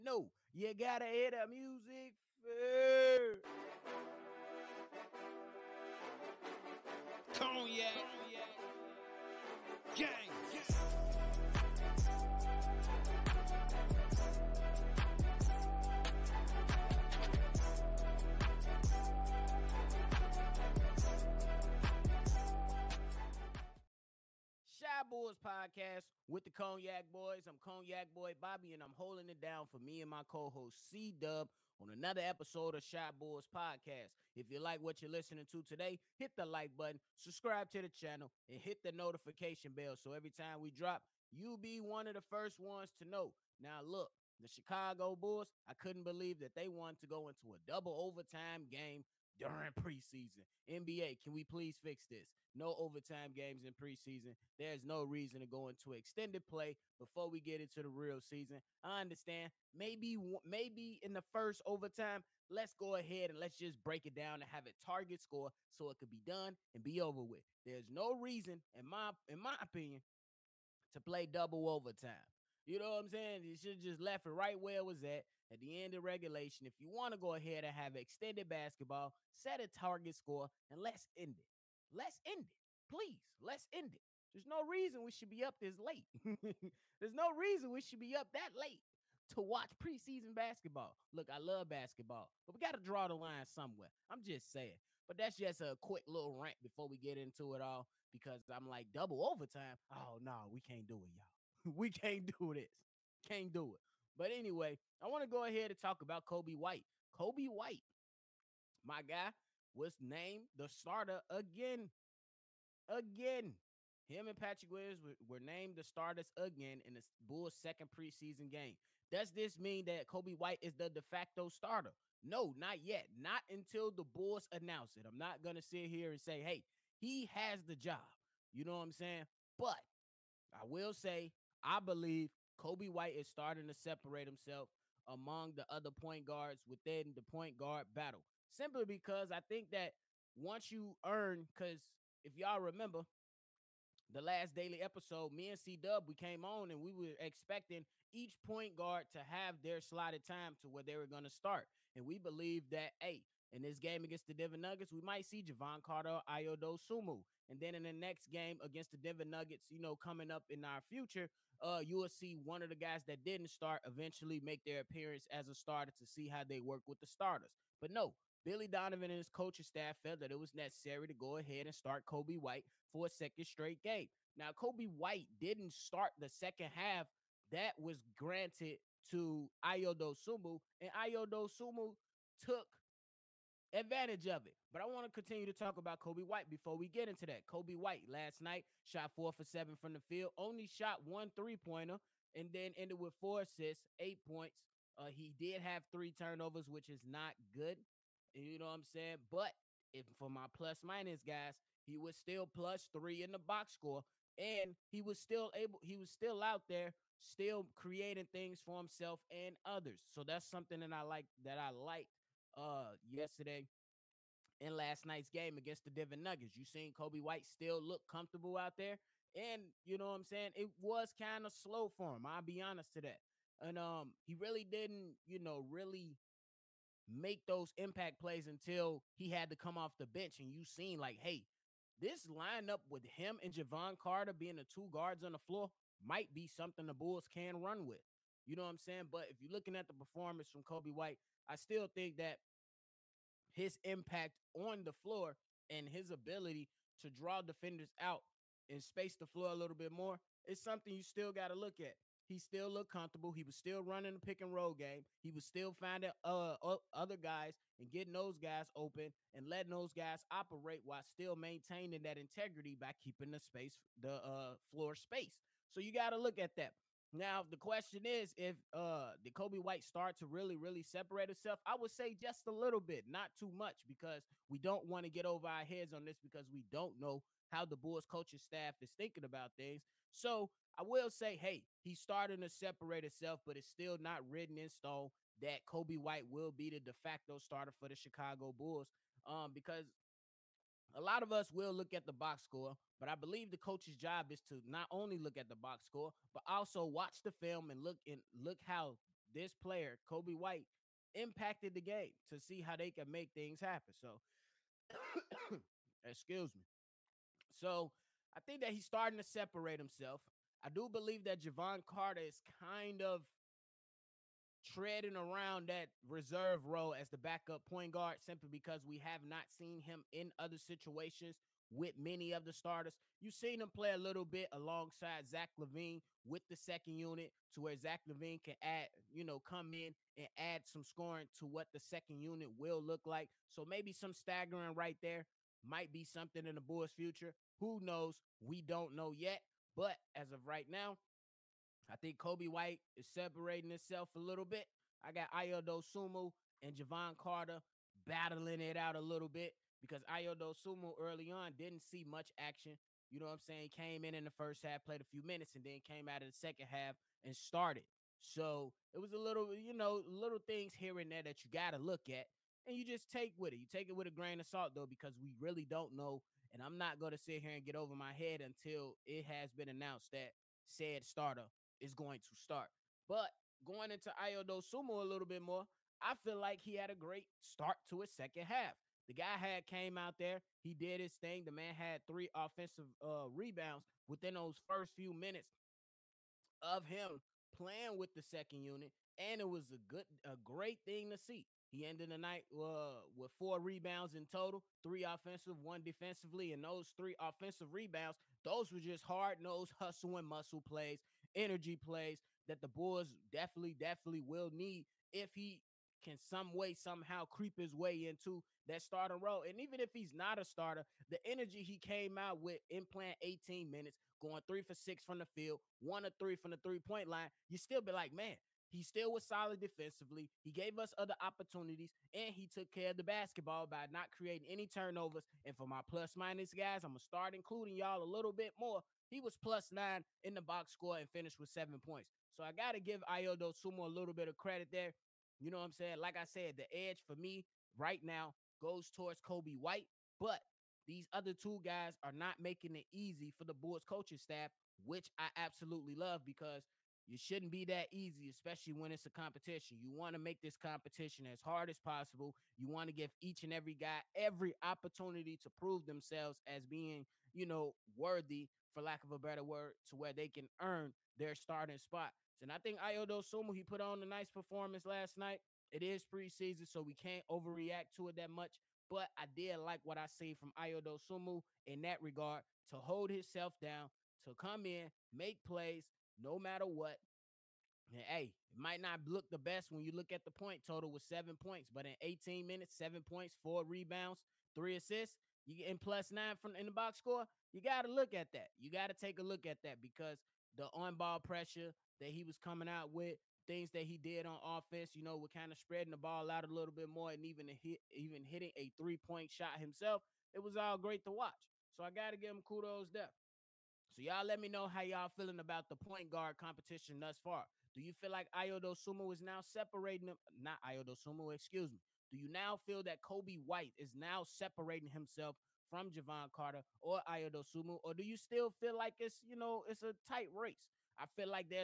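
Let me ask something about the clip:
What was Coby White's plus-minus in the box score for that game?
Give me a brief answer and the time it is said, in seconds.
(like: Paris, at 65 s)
plus 3, at 202 s.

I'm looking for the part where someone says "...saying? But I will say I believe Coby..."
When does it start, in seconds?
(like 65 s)
128 s.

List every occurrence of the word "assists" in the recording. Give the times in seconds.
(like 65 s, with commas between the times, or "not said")
193 s, 484 s.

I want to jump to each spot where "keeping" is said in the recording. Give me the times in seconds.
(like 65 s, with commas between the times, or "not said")
262 s.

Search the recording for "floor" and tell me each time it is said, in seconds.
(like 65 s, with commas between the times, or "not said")
235 s, 244 s, 249 s, 264 s.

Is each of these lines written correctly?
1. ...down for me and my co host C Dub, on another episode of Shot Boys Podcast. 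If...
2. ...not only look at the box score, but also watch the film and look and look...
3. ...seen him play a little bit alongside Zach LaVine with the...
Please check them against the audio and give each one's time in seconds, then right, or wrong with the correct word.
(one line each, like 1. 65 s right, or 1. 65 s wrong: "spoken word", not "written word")
1. 29 s right
2. 294 s right
3. 323 s right.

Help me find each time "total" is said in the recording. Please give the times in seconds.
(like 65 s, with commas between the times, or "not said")
394 s, 480 s.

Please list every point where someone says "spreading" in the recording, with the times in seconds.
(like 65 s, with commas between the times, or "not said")
495 s.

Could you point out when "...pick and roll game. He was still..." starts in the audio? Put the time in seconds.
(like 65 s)
254 s.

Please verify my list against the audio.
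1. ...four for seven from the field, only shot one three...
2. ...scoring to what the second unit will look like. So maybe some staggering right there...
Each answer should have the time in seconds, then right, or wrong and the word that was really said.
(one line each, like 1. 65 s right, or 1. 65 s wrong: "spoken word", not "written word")
1. 189 s right
2. 330 s right.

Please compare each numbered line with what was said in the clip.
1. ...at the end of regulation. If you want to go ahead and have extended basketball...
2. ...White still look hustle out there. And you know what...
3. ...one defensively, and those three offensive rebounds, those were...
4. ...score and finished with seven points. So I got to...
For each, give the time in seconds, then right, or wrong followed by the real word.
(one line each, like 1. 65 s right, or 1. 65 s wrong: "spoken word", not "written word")
1. 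75 s right
2. 217 s wrong: "comfortable", not "hustle"
3. 395 s right
4. 430 s right.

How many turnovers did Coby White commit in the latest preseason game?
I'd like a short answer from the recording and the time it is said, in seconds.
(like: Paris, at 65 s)
3, at 195 s.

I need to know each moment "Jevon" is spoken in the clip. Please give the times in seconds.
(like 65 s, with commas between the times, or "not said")
155 s, 233 s, 311 s, 346 s, 515 s.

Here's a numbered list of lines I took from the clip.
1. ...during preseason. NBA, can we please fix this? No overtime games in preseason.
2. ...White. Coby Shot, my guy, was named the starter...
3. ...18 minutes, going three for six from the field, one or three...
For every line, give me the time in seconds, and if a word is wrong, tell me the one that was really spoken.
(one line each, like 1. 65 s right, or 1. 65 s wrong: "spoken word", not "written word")
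1. 49 s right
2. 106 s wrong: "White", not "Shot"
3. 413 s right.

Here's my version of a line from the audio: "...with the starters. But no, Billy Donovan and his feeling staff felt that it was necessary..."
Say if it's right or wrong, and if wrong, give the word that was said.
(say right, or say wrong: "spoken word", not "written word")
wrong: "coaching", not "feeling".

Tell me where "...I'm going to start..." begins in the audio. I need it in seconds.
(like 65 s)
426 s.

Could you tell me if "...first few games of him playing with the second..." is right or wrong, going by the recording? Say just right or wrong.
wrong.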